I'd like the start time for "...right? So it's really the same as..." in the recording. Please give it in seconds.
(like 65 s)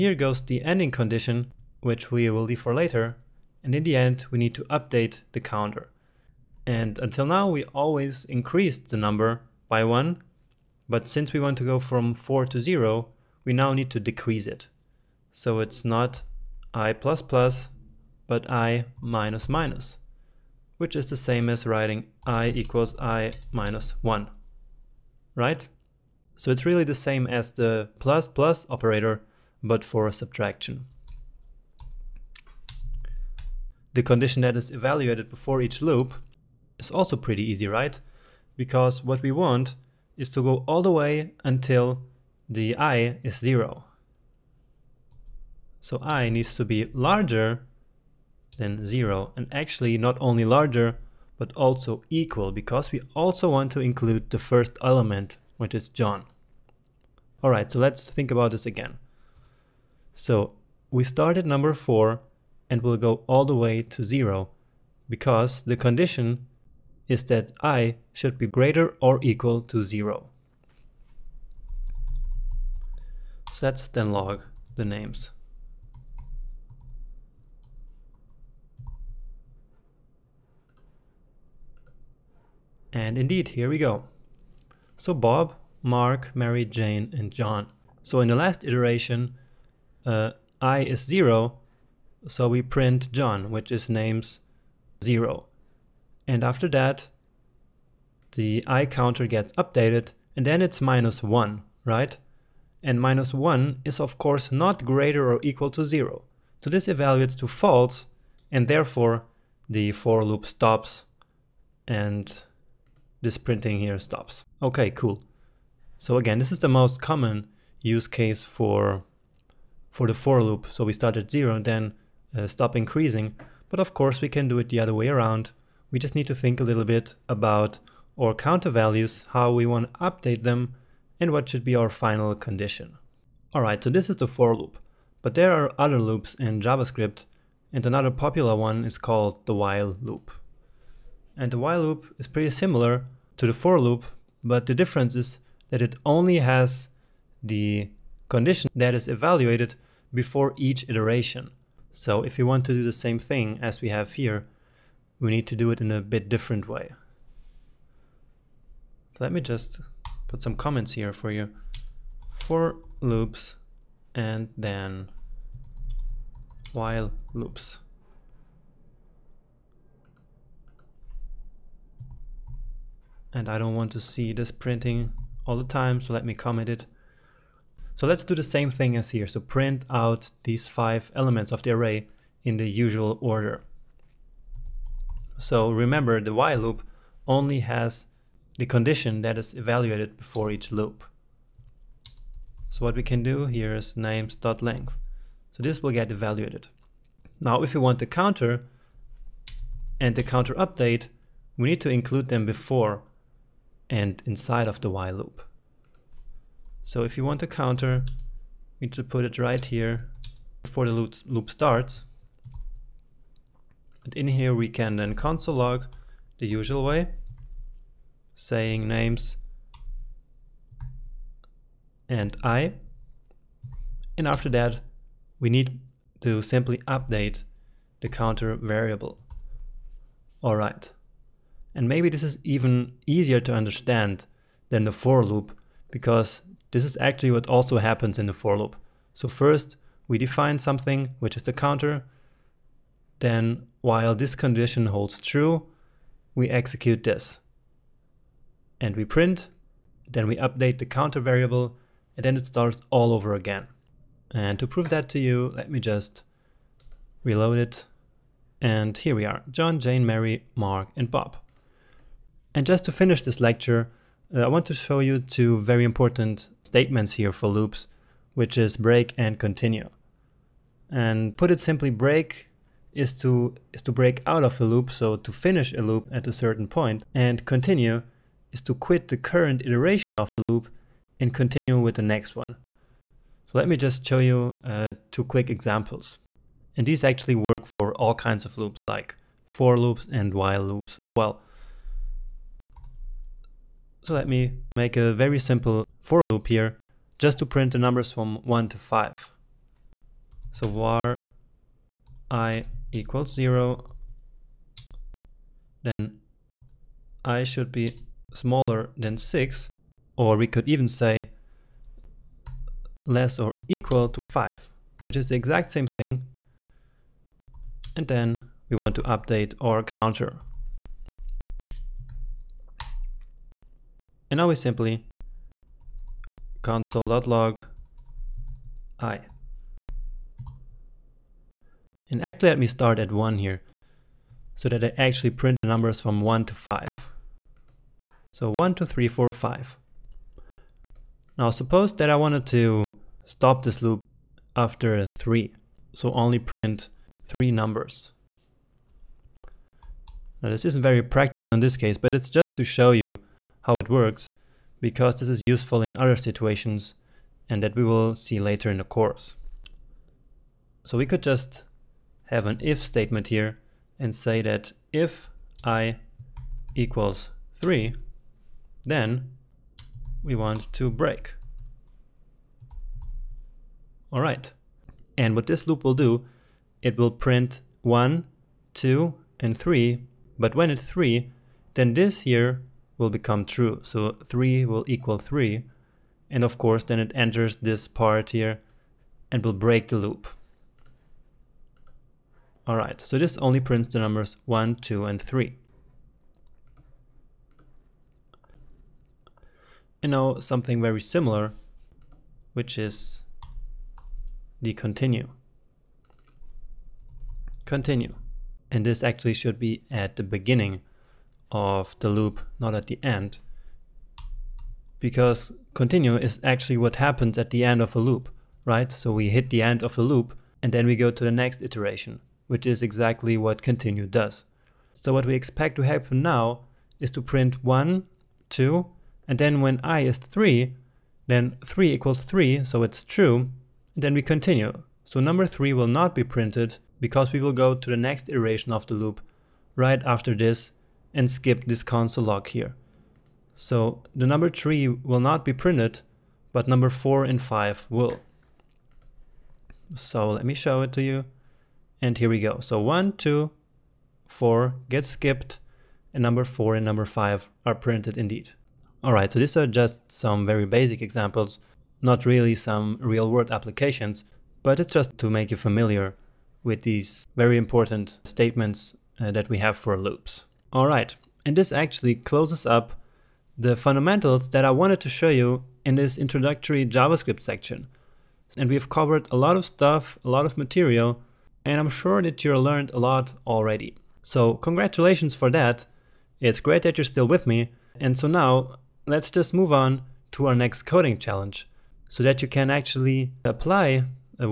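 25 s.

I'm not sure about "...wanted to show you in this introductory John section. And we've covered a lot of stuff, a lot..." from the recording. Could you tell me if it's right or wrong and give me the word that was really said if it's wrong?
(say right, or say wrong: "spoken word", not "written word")
wrong: "JavaScript", not "John".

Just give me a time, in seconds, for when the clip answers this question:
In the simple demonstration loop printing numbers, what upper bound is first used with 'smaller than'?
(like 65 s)
309 s.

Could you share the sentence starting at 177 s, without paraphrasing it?
So let's do the same thing as here.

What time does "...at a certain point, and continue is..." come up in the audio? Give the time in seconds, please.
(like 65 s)
276 s.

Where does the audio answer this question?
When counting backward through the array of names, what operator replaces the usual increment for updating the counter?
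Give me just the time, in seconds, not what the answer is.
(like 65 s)
18 s.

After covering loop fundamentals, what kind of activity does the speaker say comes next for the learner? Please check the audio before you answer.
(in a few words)
coding challenge.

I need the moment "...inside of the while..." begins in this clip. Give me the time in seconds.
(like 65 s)
204 s.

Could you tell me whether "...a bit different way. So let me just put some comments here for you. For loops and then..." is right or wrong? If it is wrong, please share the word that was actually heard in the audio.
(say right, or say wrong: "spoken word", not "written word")
right.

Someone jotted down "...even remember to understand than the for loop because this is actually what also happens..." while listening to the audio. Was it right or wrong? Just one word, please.
wrong.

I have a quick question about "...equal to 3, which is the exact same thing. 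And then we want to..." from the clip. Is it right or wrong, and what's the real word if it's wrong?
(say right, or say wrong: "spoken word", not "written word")
wrong: "5", not "3".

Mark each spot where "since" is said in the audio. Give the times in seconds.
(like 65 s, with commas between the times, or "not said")
11 s.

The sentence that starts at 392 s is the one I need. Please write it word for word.
All right, so this only prints the numbers 1, 2, and 3.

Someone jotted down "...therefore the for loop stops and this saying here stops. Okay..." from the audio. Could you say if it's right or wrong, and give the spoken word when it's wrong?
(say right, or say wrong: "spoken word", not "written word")
wrong: "printing", not "saying".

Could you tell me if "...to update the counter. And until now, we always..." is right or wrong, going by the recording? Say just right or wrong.
right.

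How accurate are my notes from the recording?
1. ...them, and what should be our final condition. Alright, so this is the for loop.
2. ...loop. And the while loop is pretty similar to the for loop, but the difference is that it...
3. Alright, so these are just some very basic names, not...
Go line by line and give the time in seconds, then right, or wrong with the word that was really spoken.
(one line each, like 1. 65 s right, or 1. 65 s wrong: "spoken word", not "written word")
1. 130 s right
2. 140 s right
3. 459 s wrong: "examples", not "names".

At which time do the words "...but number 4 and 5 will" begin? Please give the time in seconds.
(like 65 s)
446 s.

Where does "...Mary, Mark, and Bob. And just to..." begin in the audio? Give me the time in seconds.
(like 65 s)
260 s.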